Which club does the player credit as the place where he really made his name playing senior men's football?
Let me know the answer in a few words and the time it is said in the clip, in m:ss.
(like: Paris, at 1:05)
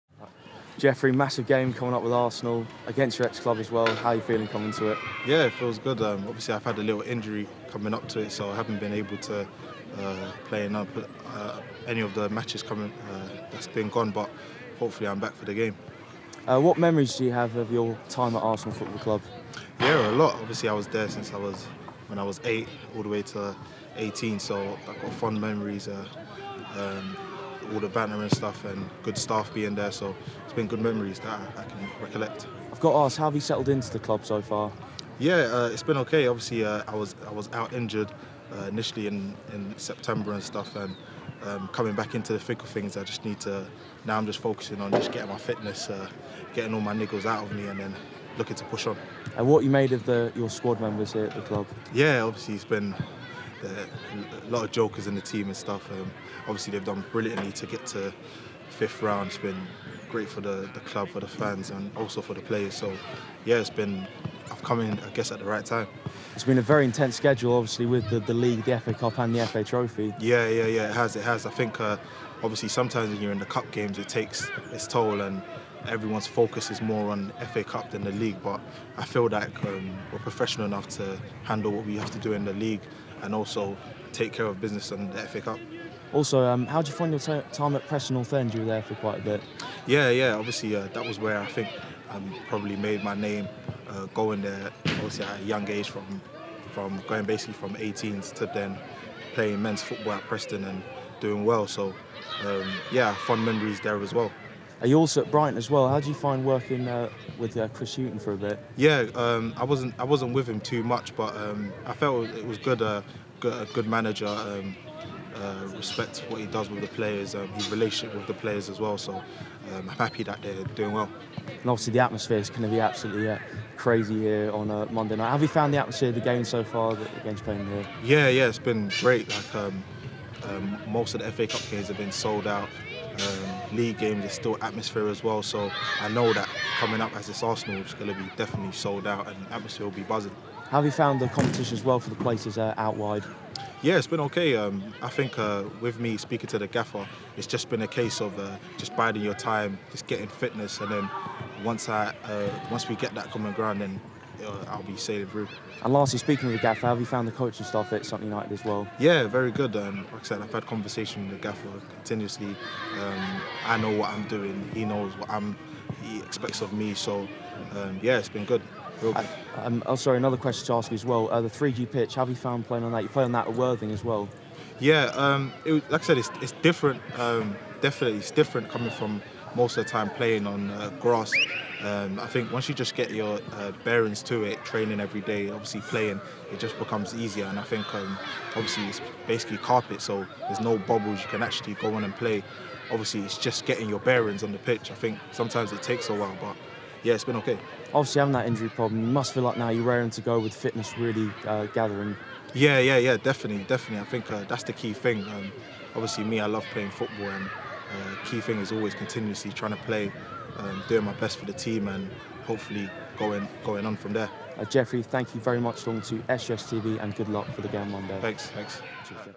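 Preston North End, at 1:27.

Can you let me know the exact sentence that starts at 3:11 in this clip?
You can actually go on and play.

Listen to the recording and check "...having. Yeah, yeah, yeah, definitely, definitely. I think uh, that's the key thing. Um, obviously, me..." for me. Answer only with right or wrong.
wrong.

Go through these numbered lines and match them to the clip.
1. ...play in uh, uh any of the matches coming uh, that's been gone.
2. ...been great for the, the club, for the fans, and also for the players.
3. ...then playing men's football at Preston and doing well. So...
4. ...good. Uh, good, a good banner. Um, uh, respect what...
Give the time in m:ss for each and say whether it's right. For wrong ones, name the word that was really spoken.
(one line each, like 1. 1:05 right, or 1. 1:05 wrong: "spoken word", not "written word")
1. 0:10 right
2. 0:59 right
3. 1:38 right
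4. 1:52 wrong: "manager", not "banner".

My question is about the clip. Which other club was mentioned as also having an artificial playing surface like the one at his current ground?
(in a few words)
Worthing.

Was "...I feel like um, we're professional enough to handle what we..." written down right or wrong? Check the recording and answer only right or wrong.
right.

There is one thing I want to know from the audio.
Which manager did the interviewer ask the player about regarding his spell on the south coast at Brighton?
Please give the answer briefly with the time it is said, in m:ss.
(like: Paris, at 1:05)
Chris Hughton, at 1:47.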